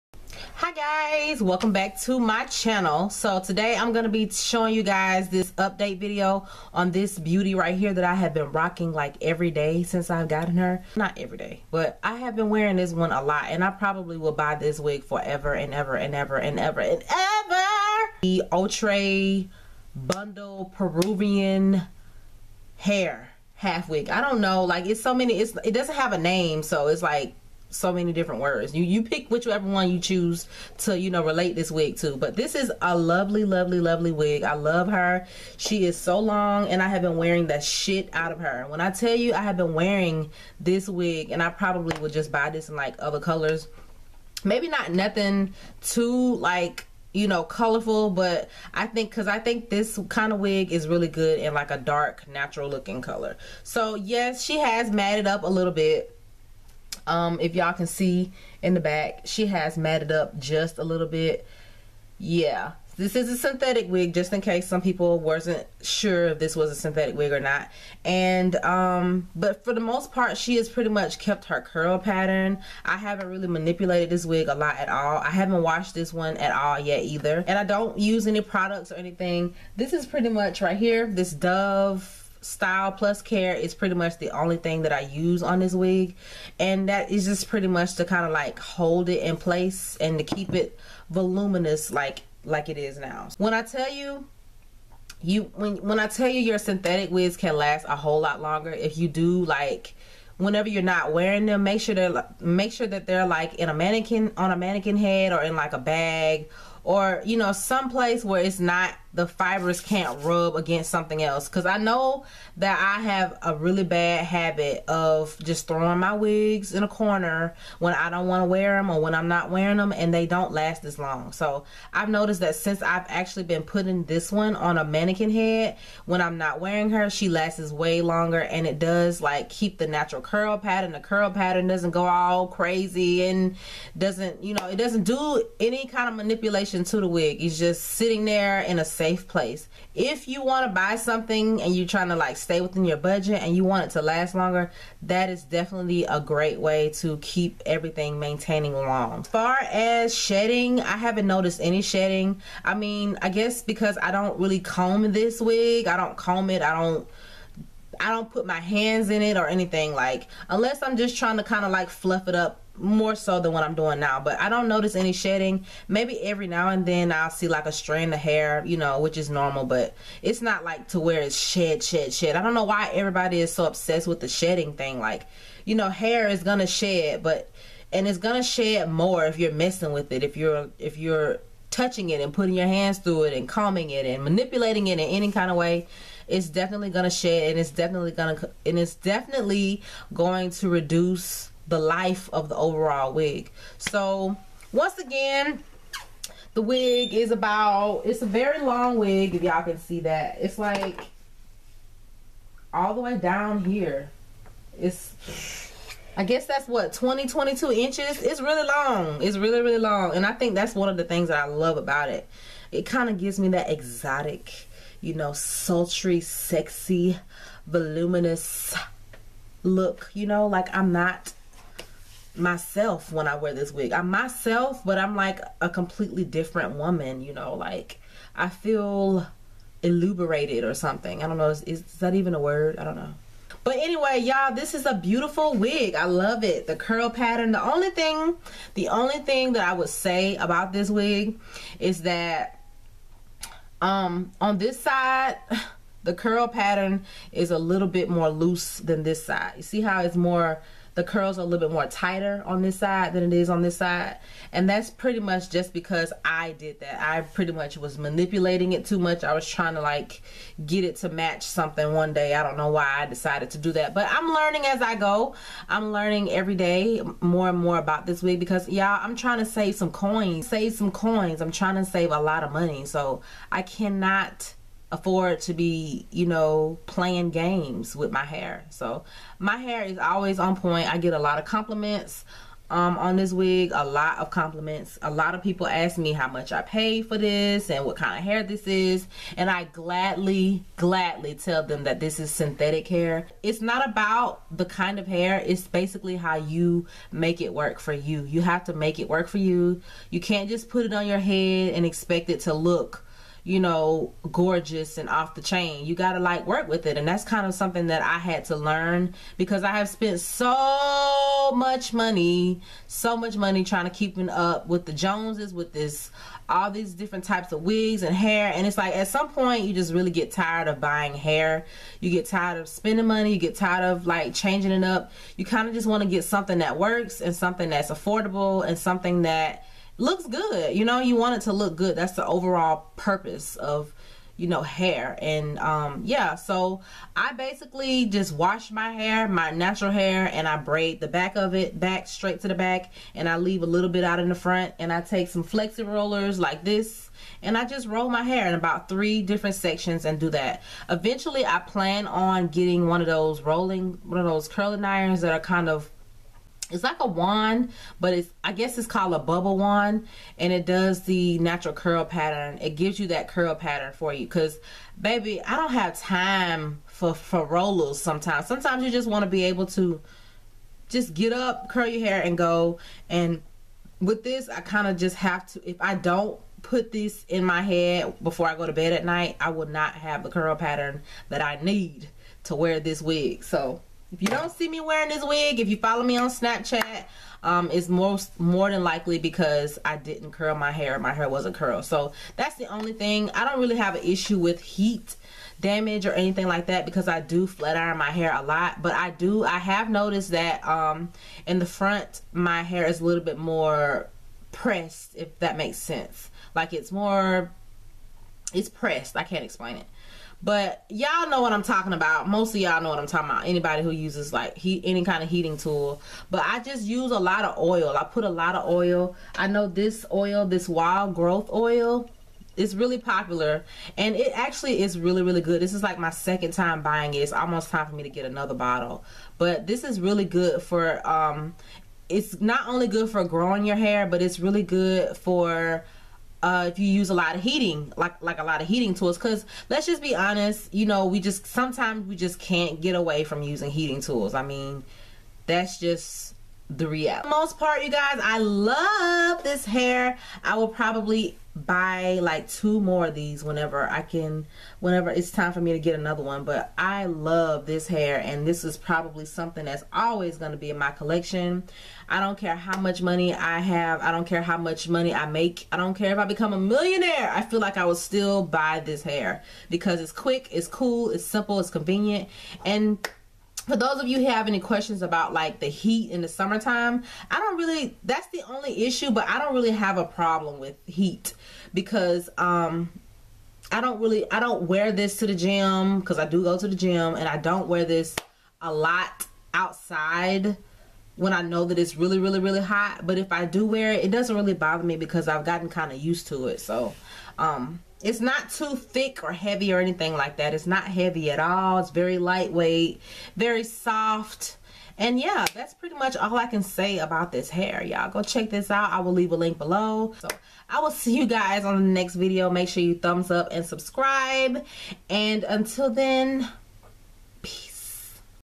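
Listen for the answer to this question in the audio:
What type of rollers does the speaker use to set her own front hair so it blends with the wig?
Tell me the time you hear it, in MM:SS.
05:45.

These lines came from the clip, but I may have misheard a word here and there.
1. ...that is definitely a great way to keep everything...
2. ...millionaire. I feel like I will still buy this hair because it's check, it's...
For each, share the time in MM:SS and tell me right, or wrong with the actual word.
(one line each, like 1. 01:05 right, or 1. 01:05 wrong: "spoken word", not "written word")
1. 02:25 right
2. 07:46 wrong: "quick", not "check".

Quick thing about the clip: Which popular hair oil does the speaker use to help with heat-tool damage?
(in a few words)
Wild Growth oil.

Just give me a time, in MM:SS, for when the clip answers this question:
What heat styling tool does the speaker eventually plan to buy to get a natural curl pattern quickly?
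05:59.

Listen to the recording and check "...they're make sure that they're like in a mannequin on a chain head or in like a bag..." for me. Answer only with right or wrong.
wrong.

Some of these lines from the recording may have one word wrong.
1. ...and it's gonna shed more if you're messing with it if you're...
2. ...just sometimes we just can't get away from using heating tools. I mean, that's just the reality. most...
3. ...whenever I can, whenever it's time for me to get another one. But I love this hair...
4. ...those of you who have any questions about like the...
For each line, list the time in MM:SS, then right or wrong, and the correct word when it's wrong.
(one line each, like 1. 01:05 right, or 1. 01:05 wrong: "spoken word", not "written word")
1. 02:57 right
2. 07:21 right
3. 07:33 right
4. 07:53 right.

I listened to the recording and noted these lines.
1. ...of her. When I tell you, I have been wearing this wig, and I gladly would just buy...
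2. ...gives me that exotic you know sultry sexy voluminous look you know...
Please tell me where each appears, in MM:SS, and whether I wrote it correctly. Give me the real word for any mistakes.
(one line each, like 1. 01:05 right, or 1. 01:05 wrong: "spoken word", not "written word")
1. 00:38 wrong: "probably", not "gladly"
2. 03:33 right.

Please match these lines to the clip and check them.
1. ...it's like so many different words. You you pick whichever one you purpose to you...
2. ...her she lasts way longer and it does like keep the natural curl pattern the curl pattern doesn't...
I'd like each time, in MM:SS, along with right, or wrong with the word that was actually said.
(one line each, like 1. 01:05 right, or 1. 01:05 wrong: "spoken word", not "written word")
1. 00:26 wrong: "choose", not "purpose"
2. 02:06 right.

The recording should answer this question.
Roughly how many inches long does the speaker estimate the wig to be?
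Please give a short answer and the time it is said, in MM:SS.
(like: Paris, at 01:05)
22 inches, at 03:27.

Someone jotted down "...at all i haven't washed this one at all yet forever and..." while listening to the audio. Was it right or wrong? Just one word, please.
wrong.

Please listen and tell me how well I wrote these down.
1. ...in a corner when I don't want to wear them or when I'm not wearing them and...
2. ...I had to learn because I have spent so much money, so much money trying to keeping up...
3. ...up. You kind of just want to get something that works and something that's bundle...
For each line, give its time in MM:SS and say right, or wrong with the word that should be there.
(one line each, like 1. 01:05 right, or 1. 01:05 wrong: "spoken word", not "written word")
1. 01:56 right
2. 05:08 right
3. 05:24 wrong: "affordable", not "bundle".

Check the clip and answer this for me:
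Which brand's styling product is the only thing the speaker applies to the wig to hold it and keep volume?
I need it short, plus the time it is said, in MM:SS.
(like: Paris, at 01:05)
Dove, at 01:21.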